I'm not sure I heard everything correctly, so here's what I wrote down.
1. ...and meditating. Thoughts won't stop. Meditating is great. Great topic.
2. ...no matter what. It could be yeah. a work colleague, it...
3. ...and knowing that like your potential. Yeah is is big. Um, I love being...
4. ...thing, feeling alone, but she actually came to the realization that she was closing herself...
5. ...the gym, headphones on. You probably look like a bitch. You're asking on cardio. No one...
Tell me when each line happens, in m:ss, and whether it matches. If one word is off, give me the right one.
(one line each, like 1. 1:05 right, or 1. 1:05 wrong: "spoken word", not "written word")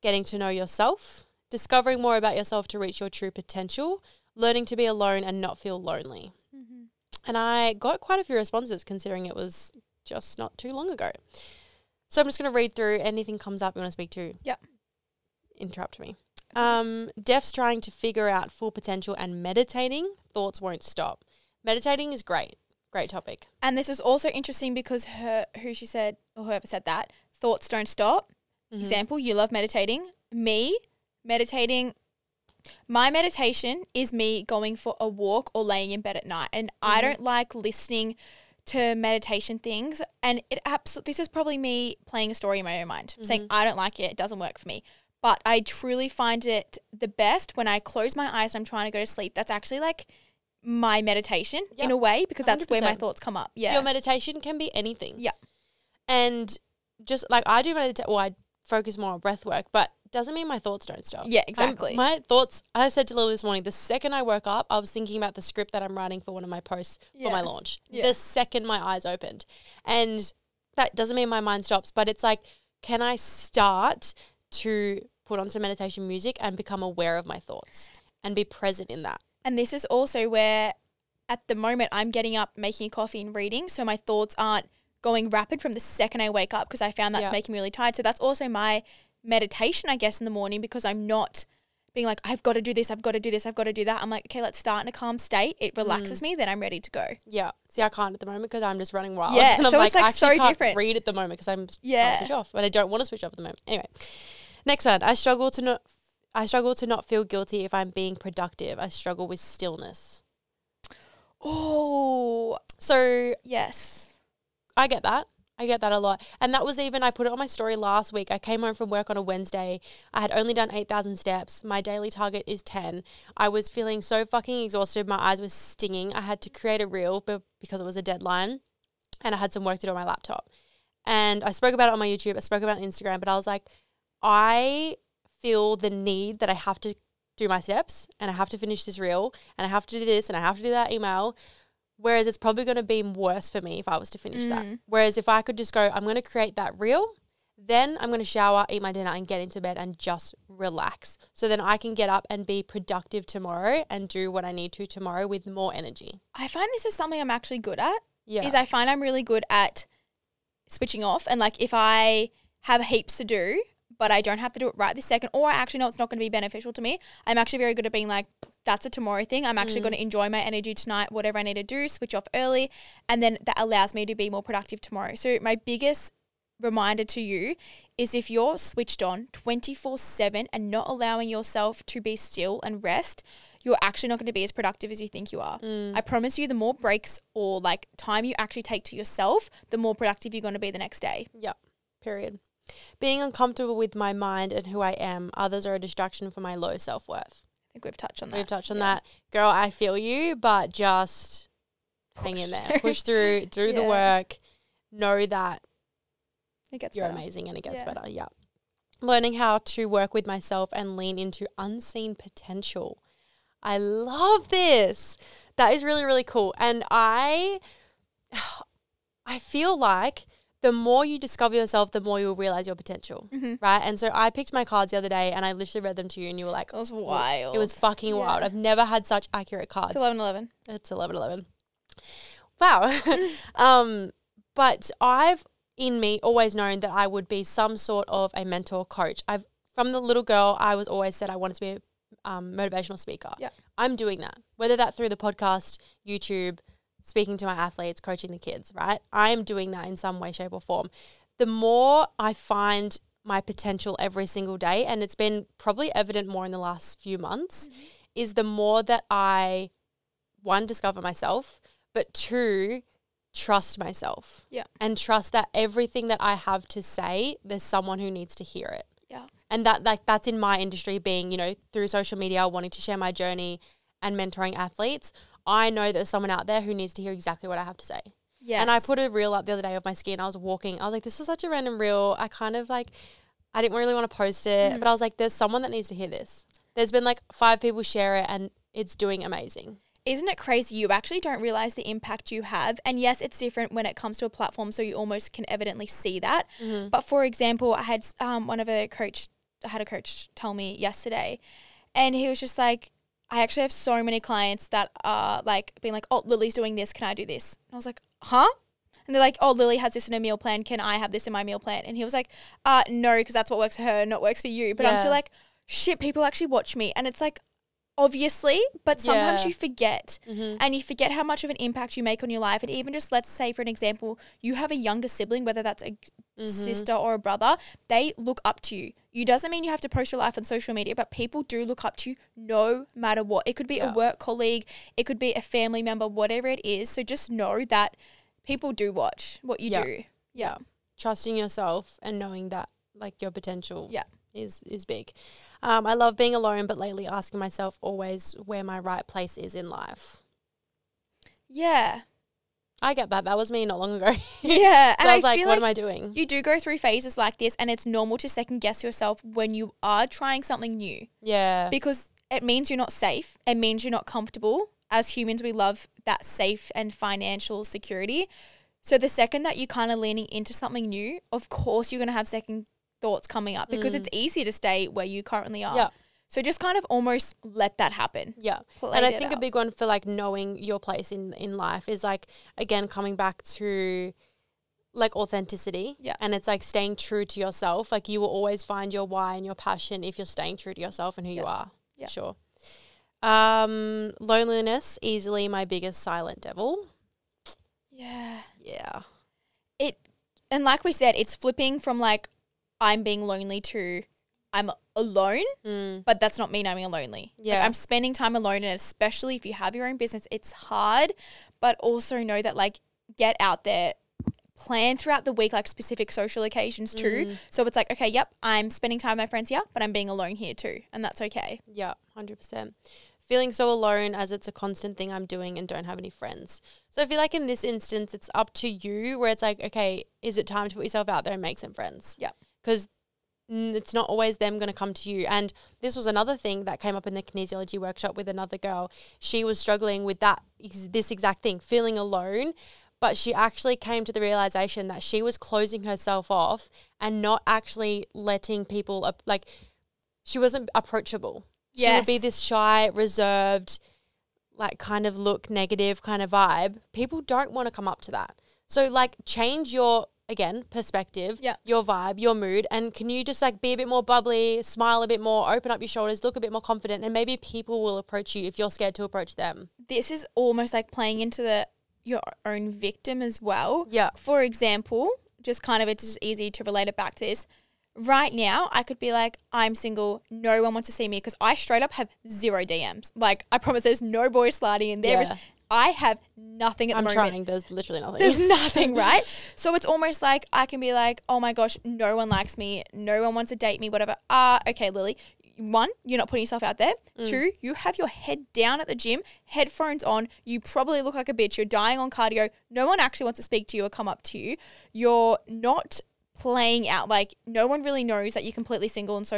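1. 0:19 right
2. 5:32 right
3. 5:42 right
4. 7:21 right
5. 8:18 wrong: "dying", not "asking".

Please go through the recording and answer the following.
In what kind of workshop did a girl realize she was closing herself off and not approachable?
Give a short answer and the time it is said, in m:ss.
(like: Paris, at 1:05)
Kinesiology workshop, at 7:17.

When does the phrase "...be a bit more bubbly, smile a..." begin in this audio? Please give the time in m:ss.
7:43.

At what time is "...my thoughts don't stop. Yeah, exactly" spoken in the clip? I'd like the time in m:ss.
1:00.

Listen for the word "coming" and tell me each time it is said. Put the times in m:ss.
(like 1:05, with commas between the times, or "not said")
6:13, 6:22.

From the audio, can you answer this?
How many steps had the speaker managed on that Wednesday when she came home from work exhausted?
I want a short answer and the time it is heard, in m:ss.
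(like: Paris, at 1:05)
8,000, at 2:00.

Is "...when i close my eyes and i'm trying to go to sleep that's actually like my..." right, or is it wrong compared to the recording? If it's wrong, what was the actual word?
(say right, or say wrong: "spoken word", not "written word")
right.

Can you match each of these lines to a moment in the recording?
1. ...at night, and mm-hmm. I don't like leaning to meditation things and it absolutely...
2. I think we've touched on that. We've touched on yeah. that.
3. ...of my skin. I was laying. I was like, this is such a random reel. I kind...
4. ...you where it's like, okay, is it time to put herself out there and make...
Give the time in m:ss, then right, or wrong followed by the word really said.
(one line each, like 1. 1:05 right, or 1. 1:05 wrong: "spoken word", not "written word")
1. 0:36 wrong: "listening", not "leaning"
2. 3:17 right
3. 4:39 wrong: "walking", not "laying"
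4. 7:08 wrong: "yourself", not "herself".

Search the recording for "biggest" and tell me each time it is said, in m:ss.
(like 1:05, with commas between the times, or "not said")
2:55, 6:35.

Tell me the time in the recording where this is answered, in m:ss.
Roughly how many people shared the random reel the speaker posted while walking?
4:47.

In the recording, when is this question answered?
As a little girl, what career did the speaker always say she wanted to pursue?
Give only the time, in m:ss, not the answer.
4:02.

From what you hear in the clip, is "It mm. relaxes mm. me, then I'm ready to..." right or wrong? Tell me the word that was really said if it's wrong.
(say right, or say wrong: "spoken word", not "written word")
right.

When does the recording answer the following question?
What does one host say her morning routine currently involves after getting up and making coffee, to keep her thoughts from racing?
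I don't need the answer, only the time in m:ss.
1:23.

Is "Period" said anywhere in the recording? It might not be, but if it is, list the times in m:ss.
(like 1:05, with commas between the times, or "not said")
3:12.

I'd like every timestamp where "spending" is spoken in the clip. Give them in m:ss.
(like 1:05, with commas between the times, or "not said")
6:47, 6:58.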